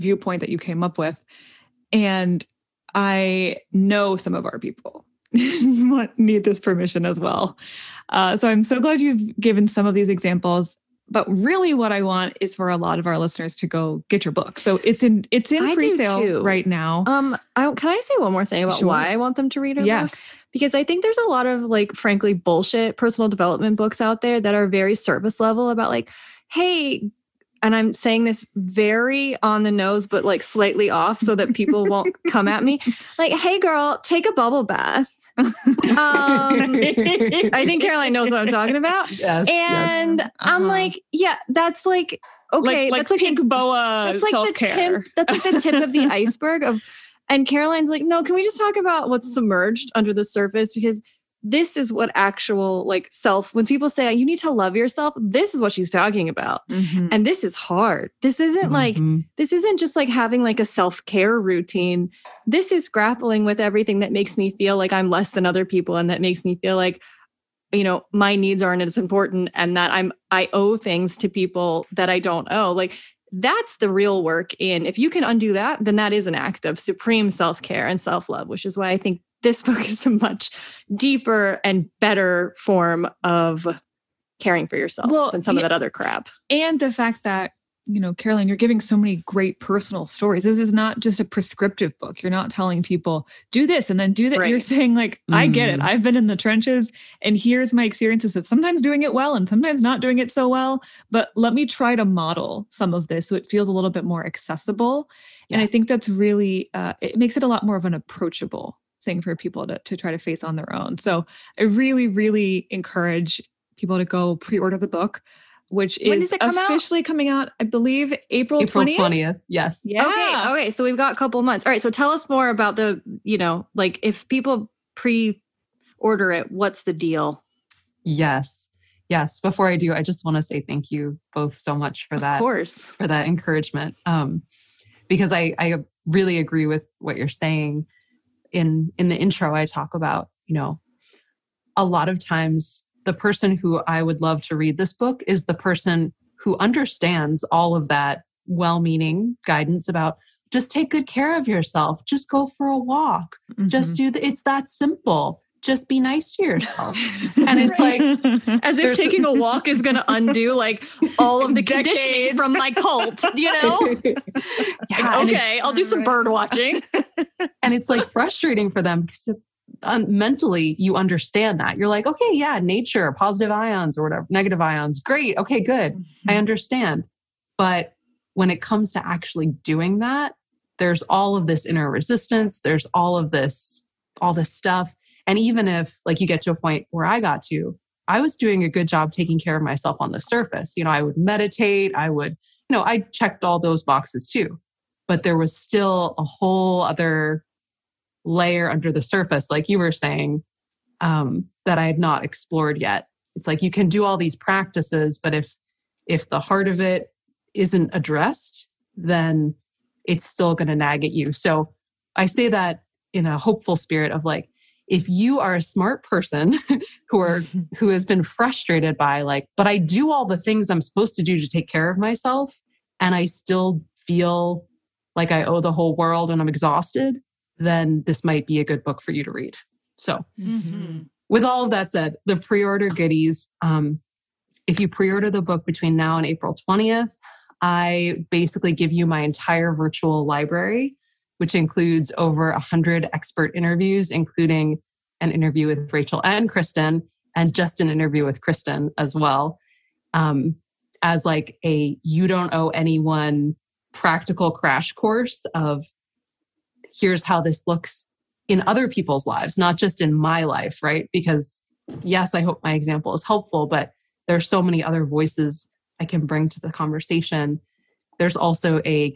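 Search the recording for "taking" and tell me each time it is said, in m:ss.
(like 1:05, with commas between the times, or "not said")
2:38, 3:09.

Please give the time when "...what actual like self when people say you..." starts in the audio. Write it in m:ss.
0:51.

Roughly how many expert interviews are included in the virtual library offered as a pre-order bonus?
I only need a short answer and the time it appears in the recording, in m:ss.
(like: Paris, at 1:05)
Over 100, at 4:02.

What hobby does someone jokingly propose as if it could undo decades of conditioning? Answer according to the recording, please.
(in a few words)
Bird watching.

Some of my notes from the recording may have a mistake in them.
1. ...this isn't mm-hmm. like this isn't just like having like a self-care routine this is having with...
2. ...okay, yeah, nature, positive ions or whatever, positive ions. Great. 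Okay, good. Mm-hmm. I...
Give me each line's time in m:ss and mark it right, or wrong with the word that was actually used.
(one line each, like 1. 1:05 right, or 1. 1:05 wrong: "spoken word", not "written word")
1. 0:58 wrong: "grappling", not "having"
2. 2:52 wrong: "negative", not "positive".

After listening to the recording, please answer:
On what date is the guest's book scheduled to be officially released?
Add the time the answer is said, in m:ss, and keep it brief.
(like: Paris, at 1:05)
April 20th, at 1:58.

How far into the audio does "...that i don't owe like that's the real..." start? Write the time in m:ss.
1:11.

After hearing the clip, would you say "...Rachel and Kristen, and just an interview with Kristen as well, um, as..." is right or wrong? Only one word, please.
right.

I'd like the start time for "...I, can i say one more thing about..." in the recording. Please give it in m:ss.
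0:17.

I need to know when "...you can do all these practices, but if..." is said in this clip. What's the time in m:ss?
3:23.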